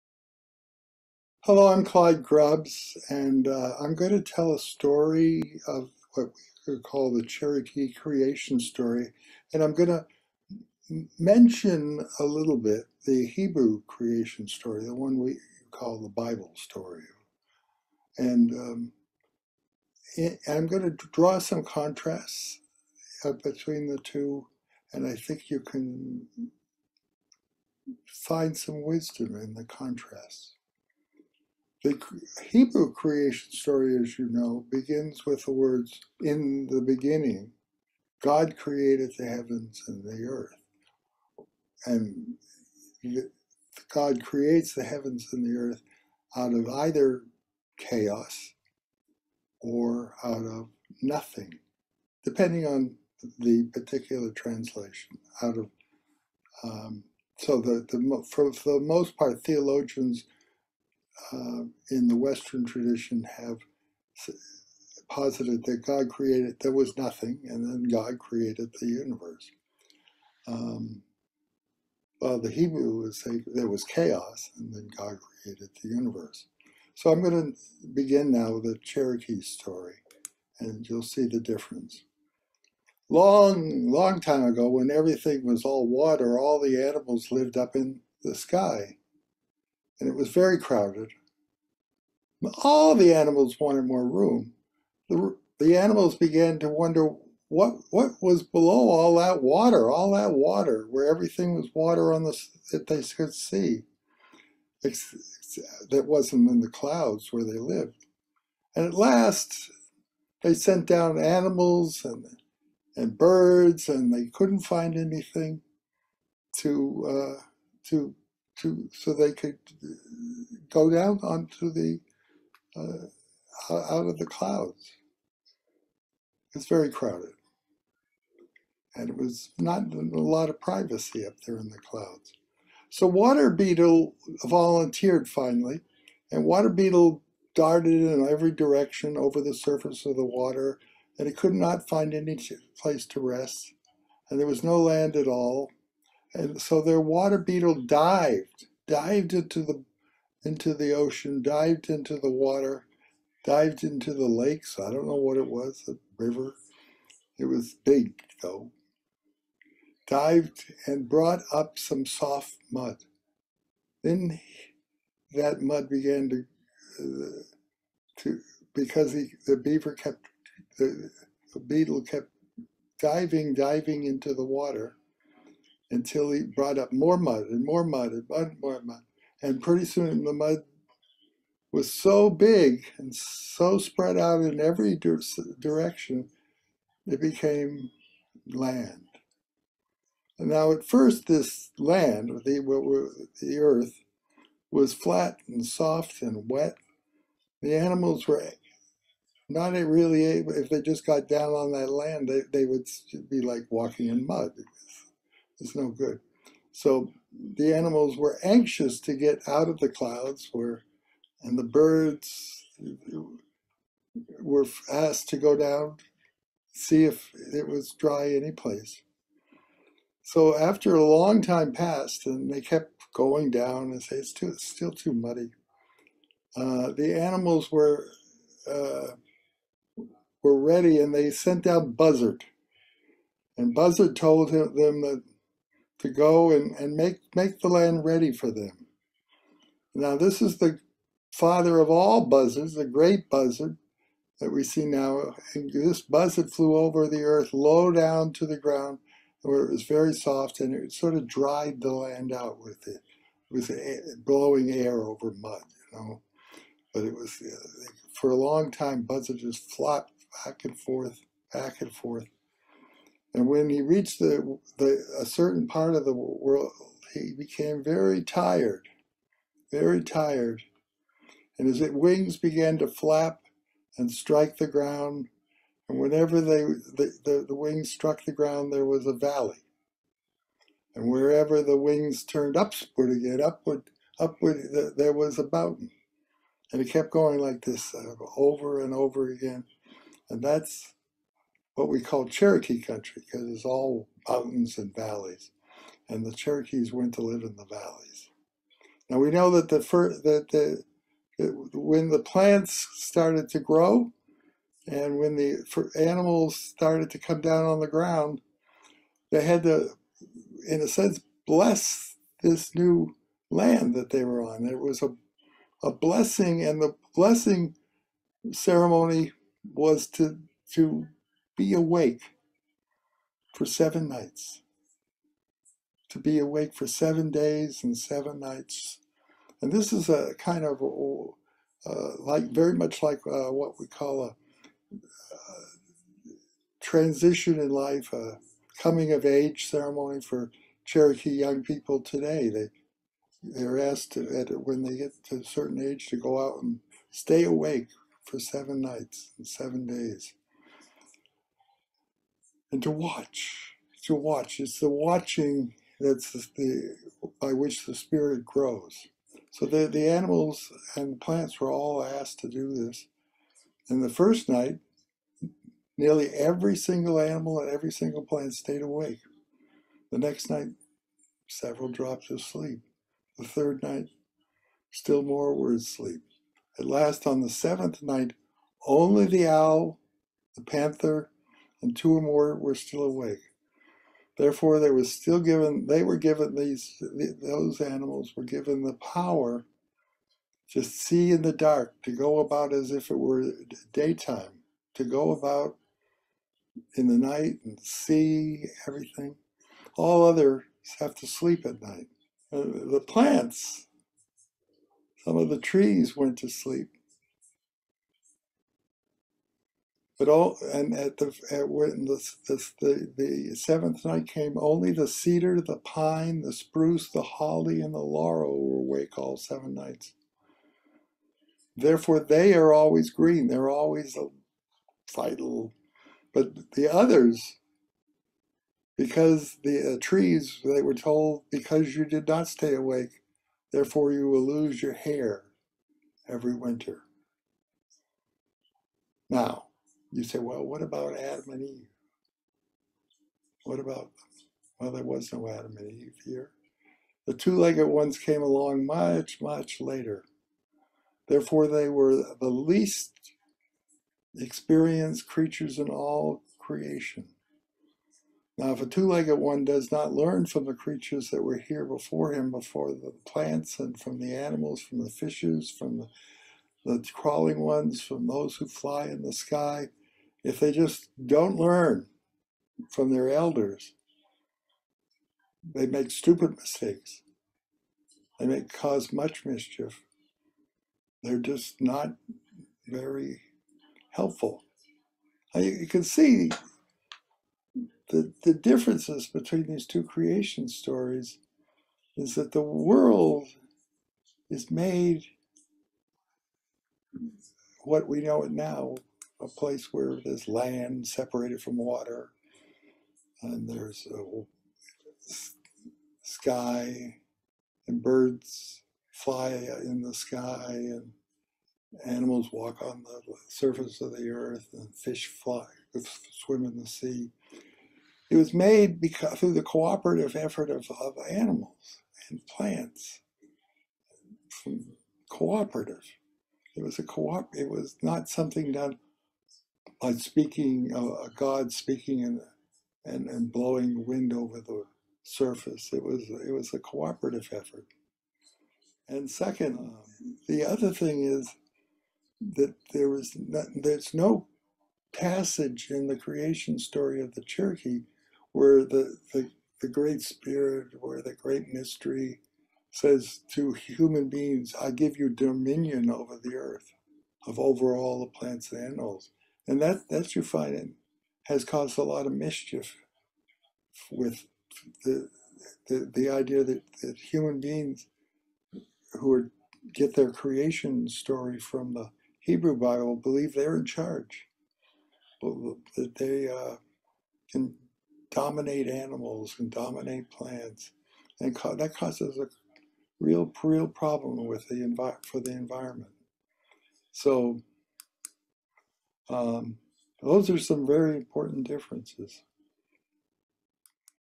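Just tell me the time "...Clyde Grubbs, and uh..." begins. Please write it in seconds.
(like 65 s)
1 s.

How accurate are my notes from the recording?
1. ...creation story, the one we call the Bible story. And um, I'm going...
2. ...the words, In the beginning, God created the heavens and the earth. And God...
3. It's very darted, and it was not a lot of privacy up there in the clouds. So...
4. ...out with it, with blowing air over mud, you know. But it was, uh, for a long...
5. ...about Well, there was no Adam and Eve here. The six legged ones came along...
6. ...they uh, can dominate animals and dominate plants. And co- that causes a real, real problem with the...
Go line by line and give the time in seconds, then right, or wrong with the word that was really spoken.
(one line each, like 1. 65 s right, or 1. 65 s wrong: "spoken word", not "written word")
1. 13 s right
2. 35 s right
3. 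126 s wrong: "crowded", not "darted"
4. 252 s right
5. 443 s wrong: "two", not "six"
6. 576 s right.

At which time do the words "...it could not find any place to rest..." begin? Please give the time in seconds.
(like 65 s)
141 s.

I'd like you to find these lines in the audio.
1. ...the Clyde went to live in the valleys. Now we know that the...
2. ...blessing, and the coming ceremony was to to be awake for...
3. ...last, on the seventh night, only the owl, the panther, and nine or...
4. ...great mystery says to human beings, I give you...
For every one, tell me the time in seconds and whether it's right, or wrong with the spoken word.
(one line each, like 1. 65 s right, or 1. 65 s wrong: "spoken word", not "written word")
1. 296 s wrong: "Cherokees", not "Clyde"
2. 315 s wrong: "blessing", not "coming"
3. 376 s wrong: "two", not "nine"
4. 551 s right.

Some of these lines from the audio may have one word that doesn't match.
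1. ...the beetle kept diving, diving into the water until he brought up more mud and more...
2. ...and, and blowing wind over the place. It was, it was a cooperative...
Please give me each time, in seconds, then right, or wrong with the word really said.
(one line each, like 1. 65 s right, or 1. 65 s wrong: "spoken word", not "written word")
1. 171 s right
2. 533 s wrong: "surface", not "place".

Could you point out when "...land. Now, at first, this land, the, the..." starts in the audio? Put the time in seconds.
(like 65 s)
188 s.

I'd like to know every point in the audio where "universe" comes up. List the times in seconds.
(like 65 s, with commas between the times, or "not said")
68 s, 75 s.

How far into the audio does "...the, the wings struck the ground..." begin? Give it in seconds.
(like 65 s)
277 s.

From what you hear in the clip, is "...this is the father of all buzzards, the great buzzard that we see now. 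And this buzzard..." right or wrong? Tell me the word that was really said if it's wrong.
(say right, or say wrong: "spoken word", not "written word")
right.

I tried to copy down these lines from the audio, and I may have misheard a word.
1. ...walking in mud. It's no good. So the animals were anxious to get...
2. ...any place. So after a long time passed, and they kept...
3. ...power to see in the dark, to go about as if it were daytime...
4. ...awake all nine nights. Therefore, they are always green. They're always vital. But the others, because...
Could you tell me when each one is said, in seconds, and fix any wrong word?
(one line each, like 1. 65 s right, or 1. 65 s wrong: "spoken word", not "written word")
1. 203 s right
2. 218 s right
3. 388 s right
4. 418 s wrong: "seven", not "nine".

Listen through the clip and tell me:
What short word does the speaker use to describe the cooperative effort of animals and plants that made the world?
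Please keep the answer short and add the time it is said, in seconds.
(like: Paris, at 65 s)
A co-op, at 526 s.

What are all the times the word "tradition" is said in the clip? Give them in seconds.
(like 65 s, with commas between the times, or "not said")
62 s.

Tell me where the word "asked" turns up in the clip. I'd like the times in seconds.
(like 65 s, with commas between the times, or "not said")
214 s, 343 s, 362 s.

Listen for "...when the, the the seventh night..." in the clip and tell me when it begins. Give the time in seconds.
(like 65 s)
411 s.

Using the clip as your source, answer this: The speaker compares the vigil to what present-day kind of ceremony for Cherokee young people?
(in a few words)
Coming of age ceremony.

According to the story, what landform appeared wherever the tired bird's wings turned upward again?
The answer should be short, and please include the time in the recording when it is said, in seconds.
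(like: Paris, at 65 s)
A mountain, at 284 s.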